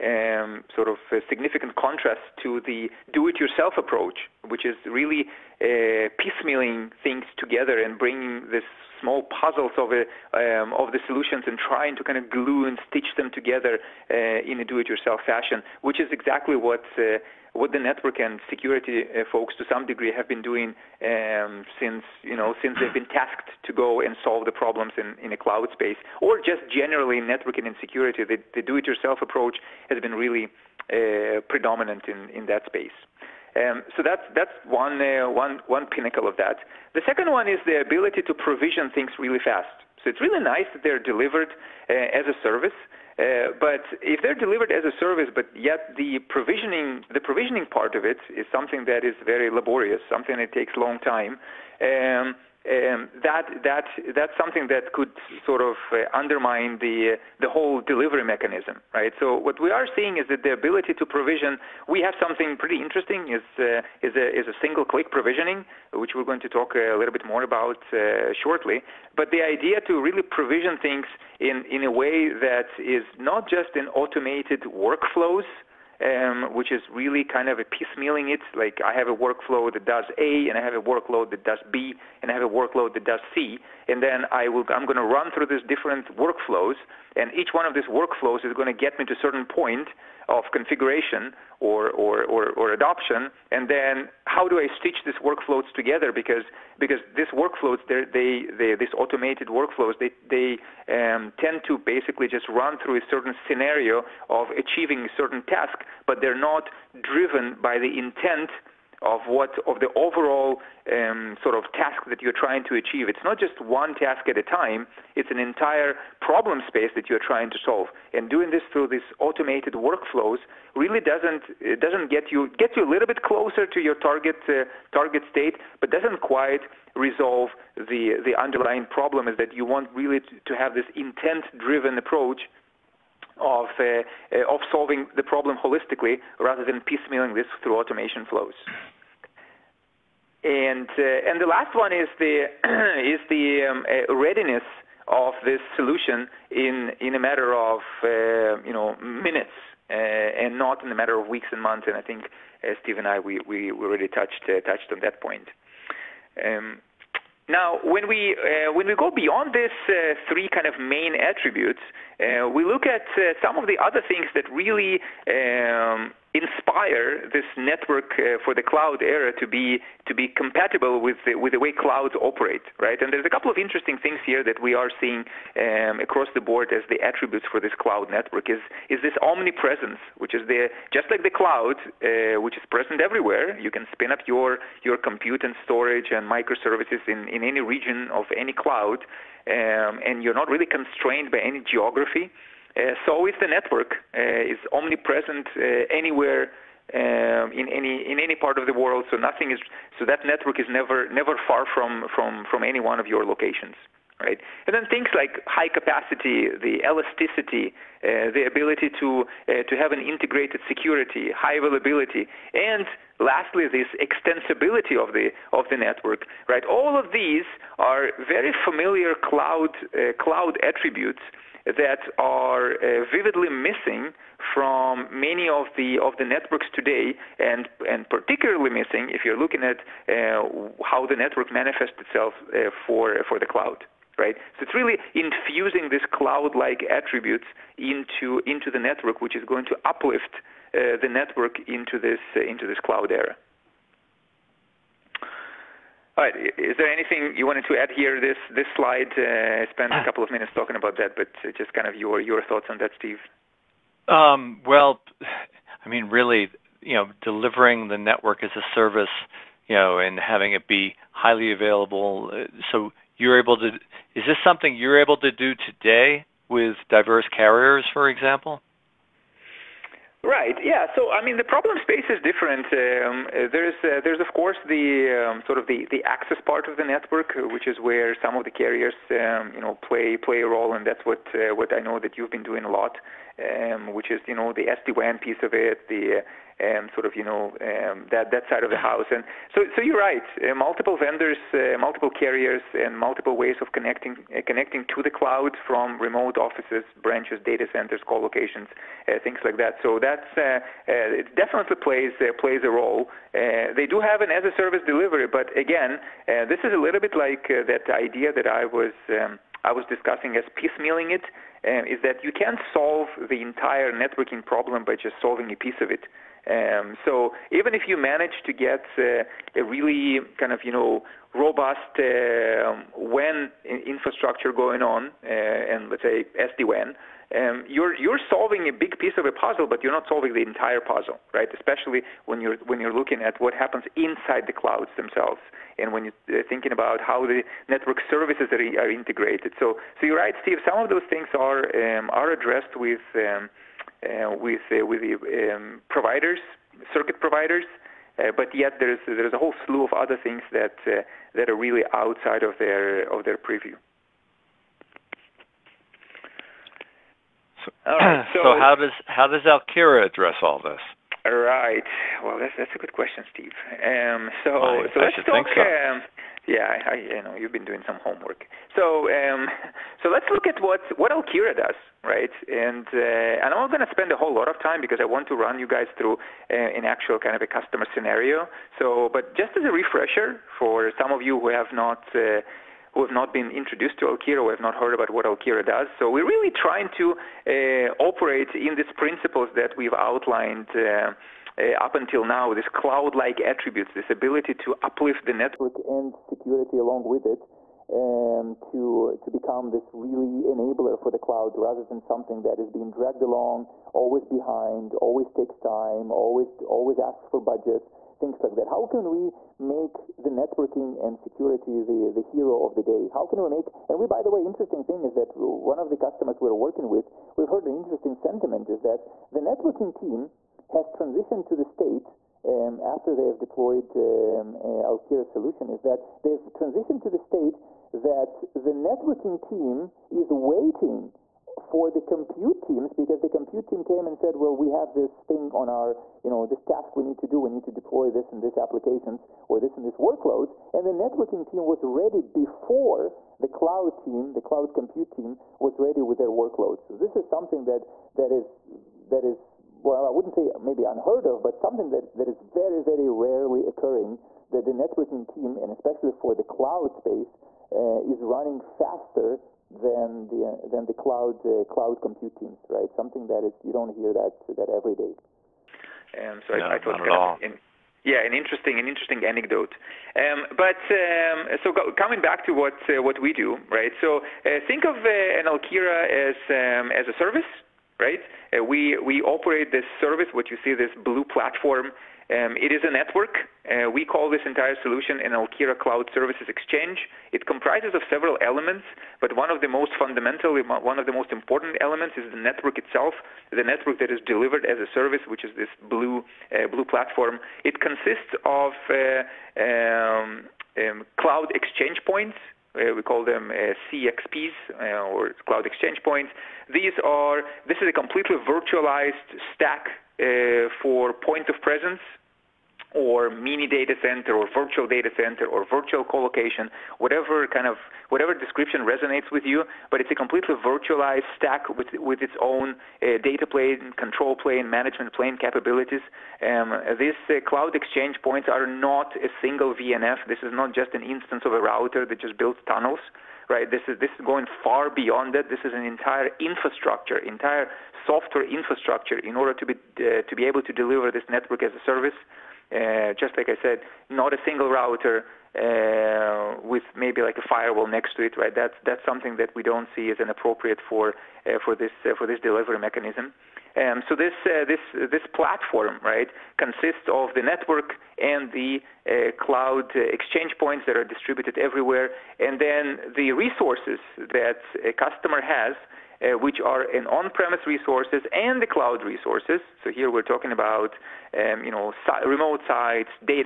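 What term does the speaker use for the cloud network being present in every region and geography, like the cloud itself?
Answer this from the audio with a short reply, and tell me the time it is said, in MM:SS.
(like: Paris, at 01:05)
omnipresence, at 02:59.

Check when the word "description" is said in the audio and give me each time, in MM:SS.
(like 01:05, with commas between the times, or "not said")
08:38.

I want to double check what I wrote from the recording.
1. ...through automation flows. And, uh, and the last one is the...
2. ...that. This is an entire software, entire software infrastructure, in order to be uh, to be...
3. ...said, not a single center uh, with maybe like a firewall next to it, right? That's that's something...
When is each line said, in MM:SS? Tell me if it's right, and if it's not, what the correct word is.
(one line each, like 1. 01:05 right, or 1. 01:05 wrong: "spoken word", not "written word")
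1. 02:17 right
2. 08:55 wrong: "infrastructure", not "software"
3. 09:03 wrong: "router", not "center".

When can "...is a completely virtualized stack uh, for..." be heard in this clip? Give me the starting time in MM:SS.
08:27.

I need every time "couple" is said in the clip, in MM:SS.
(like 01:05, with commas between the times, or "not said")
02:53, 04:10.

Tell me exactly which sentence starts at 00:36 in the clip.
The second one is the ability to provision things really fast.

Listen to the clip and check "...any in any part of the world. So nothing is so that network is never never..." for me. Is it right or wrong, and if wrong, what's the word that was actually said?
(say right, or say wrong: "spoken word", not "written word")
right.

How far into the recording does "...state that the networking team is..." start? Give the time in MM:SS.
07:07.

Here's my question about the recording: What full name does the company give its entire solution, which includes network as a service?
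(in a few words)
Alkira Cloud Services Exchange.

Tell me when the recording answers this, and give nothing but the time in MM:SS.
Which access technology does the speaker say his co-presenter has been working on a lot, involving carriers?
04:44.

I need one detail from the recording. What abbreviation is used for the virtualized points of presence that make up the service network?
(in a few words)
CXPs.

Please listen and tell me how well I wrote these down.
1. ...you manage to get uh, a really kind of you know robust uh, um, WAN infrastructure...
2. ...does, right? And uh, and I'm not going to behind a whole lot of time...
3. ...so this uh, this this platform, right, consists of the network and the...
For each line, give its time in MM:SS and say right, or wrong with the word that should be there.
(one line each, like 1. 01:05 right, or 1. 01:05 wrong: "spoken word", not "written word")
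1. 05:17 right
2. 06:11 wrong: "spend", not "behind"
3. 09:14 right.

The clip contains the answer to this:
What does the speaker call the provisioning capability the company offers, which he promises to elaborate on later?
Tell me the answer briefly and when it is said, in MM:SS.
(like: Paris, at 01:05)
single click provisioning, at 01:04.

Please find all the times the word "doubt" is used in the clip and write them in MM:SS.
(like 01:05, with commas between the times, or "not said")
not said.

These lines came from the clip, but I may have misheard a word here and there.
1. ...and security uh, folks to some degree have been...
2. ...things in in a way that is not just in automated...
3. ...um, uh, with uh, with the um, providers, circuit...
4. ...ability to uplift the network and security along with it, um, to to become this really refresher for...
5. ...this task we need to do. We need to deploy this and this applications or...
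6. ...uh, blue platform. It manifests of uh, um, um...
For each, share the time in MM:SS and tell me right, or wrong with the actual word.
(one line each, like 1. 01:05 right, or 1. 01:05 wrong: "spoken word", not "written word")
1. 00:18 right
2. 01:10 right
3. 05:43 right
4. 06:34 wrong: "enabler", not "refresher"
5. 07:16 right
6. 08:16 wrong: "consists", not "manifests".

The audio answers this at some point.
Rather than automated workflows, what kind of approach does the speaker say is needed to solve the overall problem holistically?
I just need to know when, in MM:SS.
02:10.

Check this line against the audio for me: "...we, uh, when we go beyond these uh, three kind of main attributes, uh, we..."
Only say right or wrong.
right.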